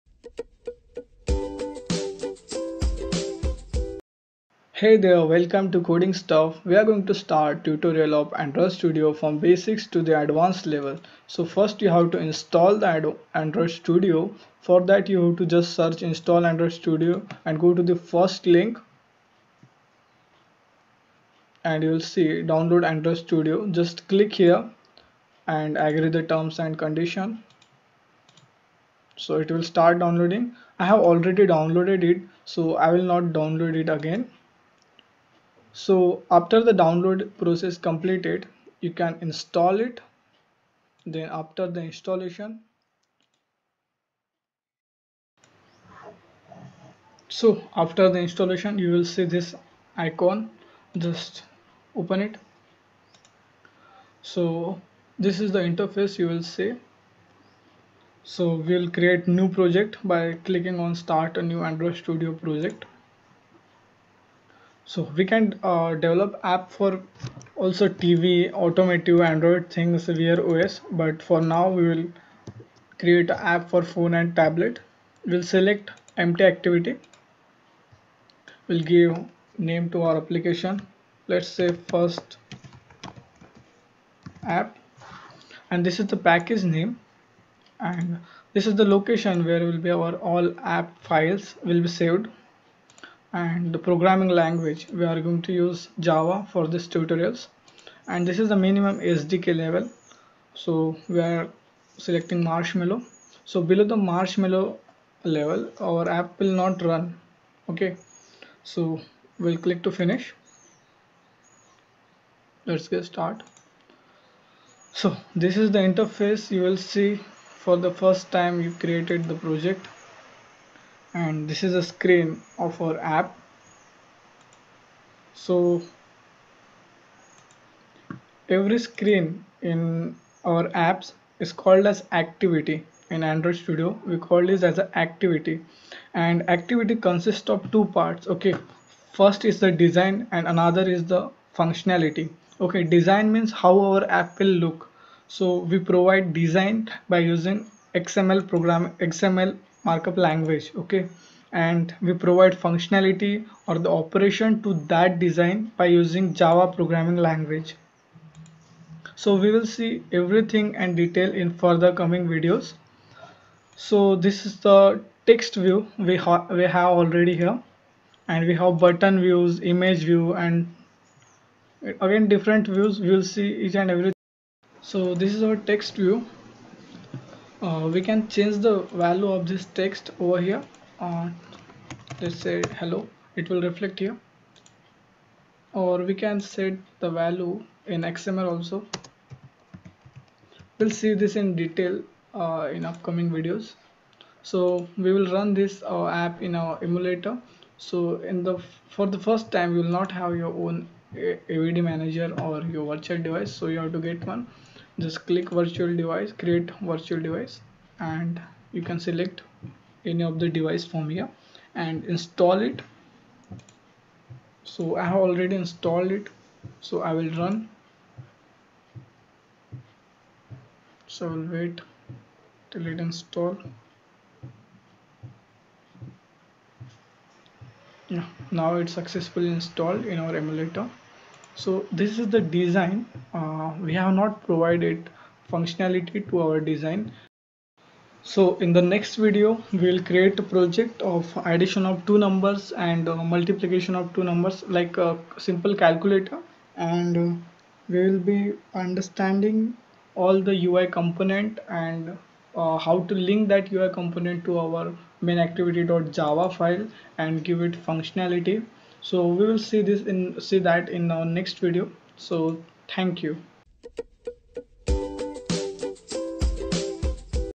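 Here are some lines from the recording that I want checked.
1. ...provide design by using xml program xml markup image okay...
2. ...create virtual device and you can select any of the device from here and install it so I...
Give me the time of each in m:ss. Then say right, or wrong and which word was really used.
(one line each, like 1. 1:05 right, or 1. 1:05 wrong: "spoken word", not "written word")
1. 2:25 wrong: "language", not "image"
2. 3:26 right.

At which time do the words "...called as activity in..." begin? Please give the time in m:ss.
2:11.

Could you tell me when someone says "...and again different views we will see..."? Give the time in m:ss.
2:50.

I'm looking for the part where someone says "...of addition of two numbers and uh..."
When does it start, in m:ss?
4:01.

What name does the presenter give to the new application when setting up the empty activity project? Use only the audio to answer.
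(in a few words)
First App.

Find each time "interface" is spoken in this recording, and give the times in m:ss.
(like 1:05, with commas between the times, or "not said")
0:55, 1:55.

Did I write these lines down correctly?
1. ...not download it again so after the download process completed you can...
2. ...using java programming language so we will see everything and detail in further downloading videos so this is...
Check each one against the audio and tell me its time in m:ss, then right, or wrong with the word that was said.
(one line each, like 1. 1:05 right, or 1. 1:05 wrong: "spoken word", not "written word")
1. 0:33 right
2. 2:35 wrong: "coming", not "downloading".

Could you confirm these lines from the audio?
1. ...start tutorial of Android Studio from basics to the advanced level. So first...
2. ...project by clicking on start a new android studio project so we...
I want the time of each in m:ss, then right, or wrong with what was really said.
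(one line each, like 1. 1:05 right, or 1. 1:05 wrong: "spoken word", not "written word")
1. 0:07 right
2. 0:59 right.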